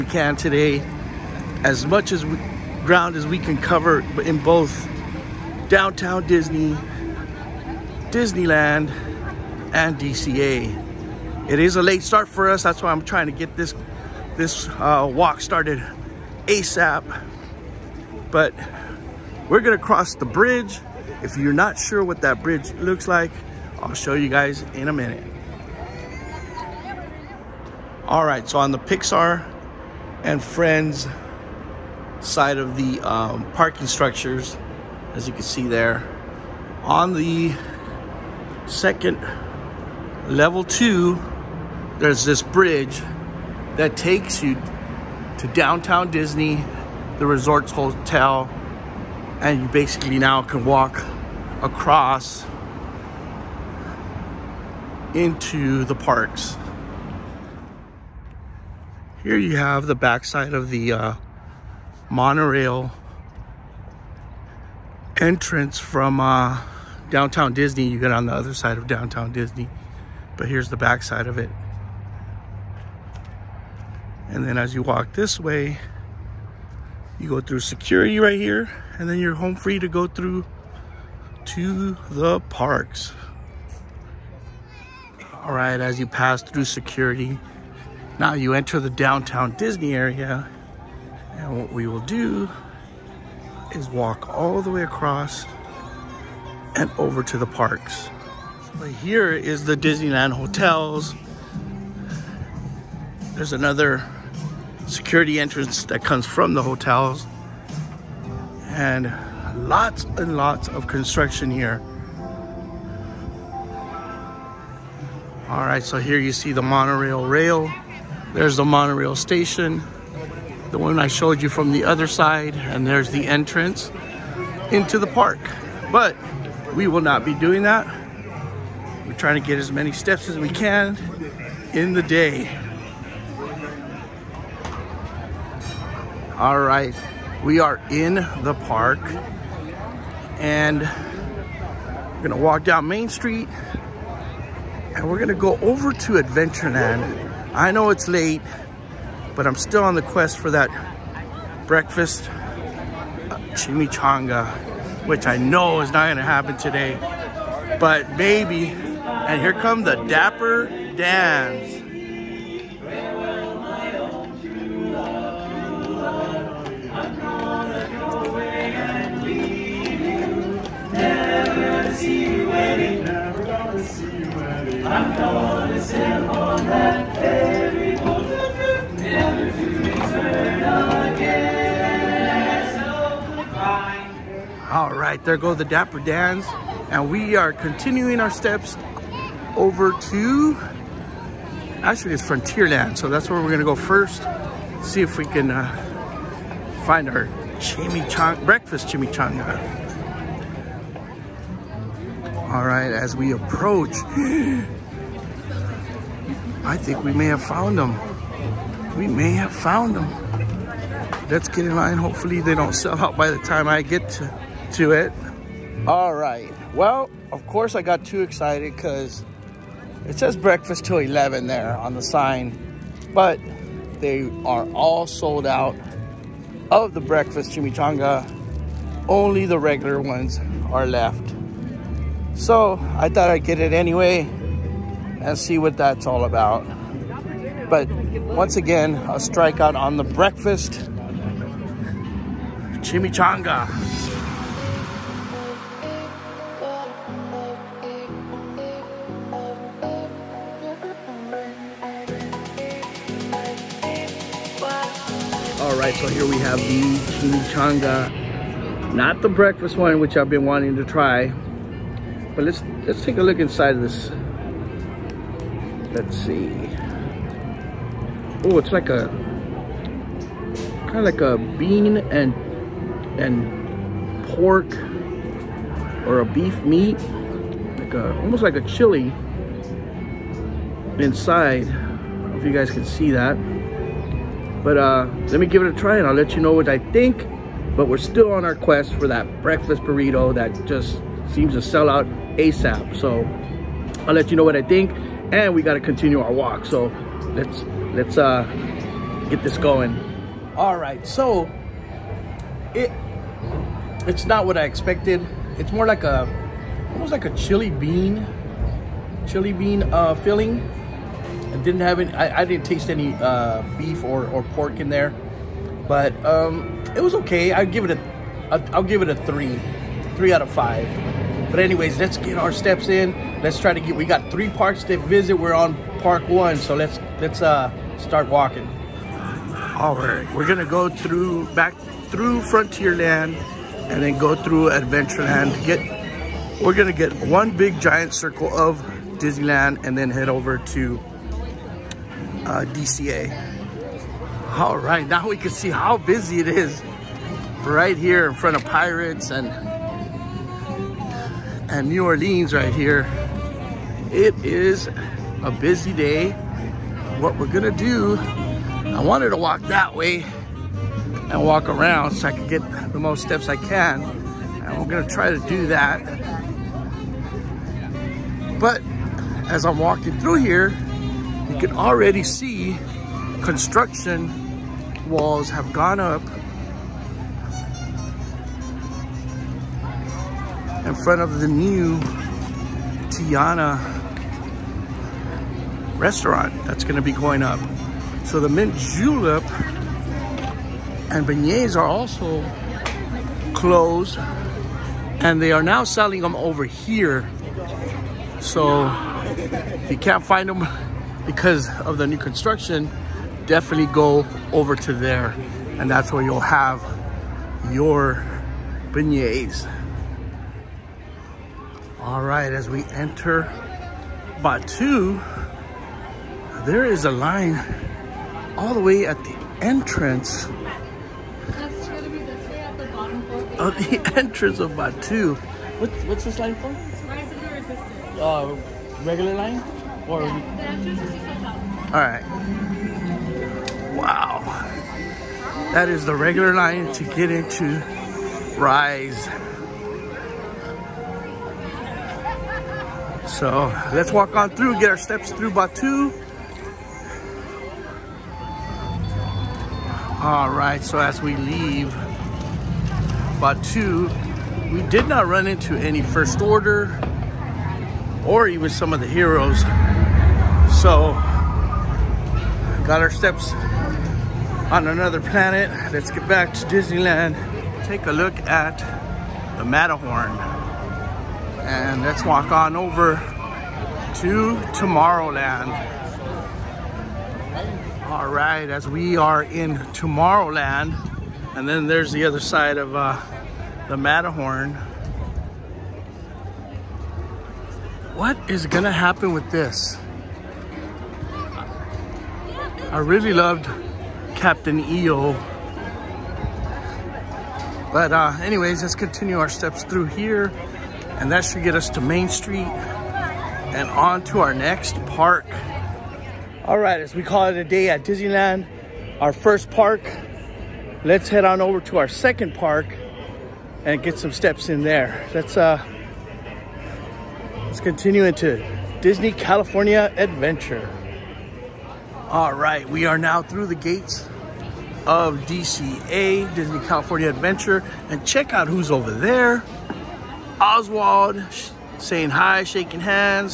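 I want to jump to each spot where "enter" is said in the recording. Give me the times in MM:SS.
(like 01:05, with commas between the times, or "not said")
01:28, 06:52.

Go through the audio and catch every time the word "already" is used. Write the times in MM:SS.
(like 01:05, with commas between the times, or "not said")
06:11.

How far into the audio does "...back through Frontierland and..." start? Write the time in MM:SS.
05:31.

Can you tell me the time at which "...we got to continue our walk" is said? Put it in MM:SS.
04:55.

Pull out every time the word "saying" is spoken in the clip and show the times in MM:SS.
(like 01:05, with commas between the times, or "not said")
08:51.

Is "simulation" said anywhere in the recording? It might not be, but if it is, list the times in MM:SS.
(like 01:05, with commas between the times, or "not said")
not said.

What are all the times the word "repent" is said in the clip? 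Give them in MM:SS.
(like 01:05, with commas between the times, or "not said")
not said.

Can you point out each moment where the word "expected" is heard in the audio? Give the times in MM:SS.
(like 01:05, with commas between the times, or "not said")
05:04.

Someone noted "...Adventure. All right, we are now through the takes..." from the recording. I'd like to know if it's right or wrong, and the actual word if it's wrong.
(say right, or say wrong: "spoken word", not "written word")
wrong: "gates", not "takes".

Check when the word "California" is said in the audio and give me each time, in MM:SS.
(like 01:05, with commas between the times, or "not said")
08:39, 08:46.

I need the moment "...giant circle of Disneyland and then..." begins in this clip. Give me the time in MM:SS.
05:37.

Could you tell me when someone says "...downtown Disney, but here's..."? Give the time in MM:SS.
01:08.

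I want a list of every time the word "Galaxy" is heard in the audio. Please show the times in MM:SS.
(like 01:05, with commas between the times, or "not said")
not said.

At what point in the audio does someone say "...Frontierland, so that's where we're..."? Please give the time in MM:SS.
03:12.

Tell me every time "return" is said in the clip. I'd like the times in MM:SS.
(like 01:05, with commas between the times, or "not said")
not said.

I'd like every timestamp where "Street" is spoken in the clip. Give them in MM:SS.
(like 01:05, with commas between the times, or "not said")
02:23, 08:22.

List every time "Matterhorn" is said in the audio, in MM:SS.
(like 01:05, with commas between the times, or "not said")
07:49, 08:03.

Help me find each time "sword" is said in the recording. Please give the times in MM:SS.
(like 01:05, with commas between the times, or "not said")
not said.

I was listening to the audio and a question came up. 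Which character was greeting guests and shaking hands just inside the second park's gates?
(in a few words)
Oswald.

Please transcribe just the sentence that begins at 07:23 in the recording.
So let's walk on through, get our steps through Batuu.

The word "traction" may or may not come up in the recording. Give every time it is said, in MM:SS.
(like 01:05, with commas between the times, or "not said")
not said.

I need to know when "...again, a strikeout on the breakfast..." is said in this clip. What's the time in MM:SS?
03:58.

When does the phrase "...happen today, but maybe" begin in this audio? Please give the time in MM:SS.
02:36.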